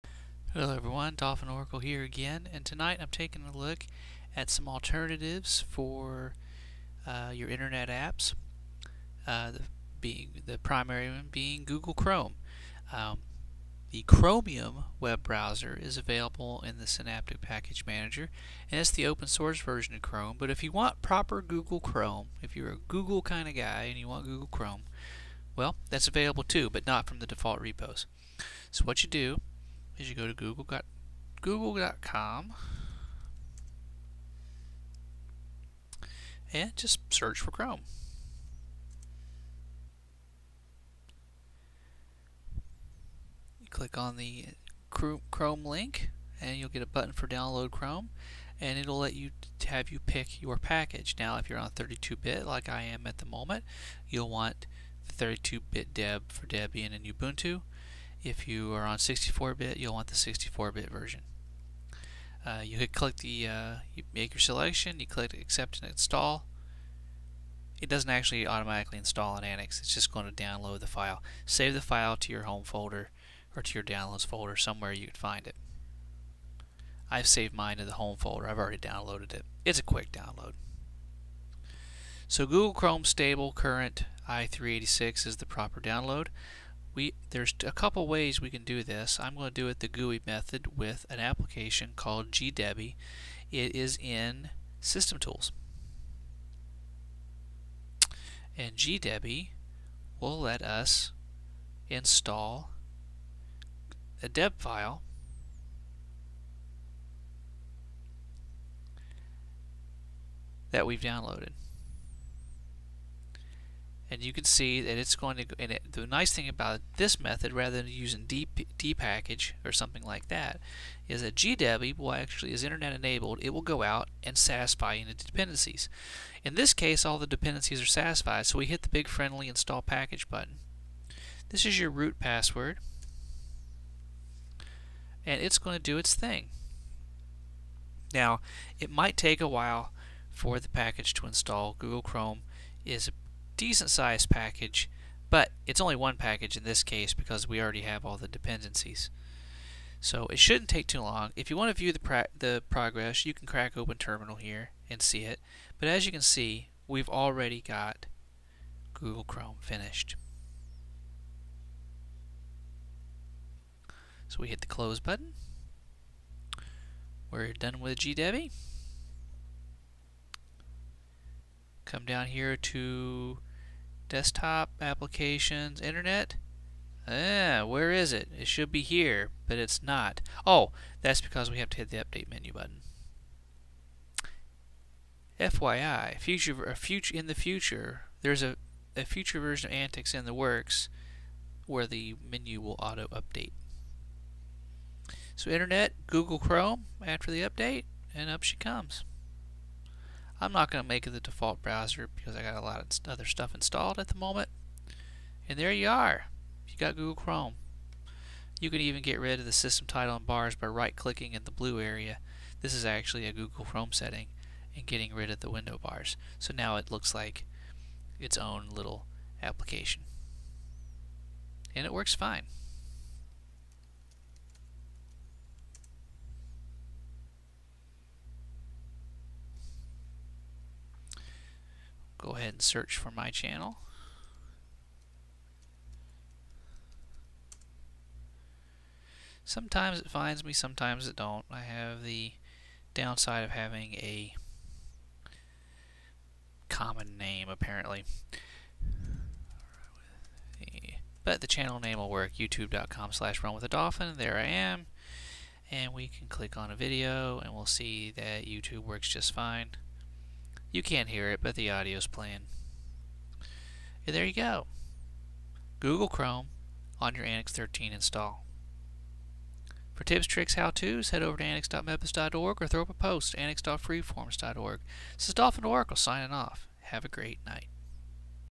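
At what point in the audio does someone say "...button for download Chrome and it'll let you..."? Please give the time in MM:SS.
00:46.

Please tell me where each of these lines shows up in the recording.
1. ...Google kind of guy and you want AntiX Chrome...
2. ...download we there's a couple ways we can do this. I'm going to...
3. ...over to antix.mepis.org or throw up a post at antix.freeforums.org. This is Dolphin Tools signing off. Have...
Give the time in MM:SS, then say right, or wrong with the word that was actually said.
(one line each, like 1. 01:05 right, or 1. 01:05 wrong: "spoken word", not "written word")
1. 00:22 wrong: "Google", not "AntiX"
2. 01:25 right
3. 04:31 wrong: "Oracle", not "Tools".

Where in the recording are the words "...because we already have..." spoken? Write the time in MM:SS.
02:27.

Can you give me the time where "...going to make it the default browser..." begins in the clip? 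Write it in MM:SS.
03:20.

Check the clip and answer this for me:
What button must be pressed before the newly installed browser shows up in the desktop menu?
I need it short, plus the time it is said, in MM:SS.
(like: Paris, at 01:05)
update menu, at 03:02.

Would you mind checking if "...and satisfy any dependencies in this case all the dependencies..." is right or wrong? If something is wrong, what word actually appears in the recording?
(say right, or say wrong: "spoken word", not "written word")
right.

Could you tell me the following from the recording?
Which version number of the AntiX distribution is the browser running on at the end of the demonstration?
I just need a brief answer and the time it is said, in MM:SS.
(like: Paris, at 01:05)
13, at 04:27.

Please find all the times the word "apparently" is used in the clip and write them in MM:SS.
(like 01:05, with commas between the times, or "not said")
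04:07.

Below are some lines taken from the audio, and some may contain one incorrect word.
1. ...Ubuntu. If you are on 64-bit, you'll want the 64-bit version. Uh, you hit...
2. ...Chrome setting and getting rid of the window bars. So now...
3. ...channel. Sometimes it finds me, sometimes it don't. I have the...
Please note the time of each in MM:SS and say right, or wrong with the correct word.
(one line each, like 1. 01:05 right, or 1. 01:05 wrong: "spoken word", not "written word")
1. 00:57 right
2. 03:33 right
3. 03:53 right.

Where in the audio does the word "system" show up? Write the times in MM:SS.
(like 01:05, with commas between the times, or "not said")
01:34, 03:29.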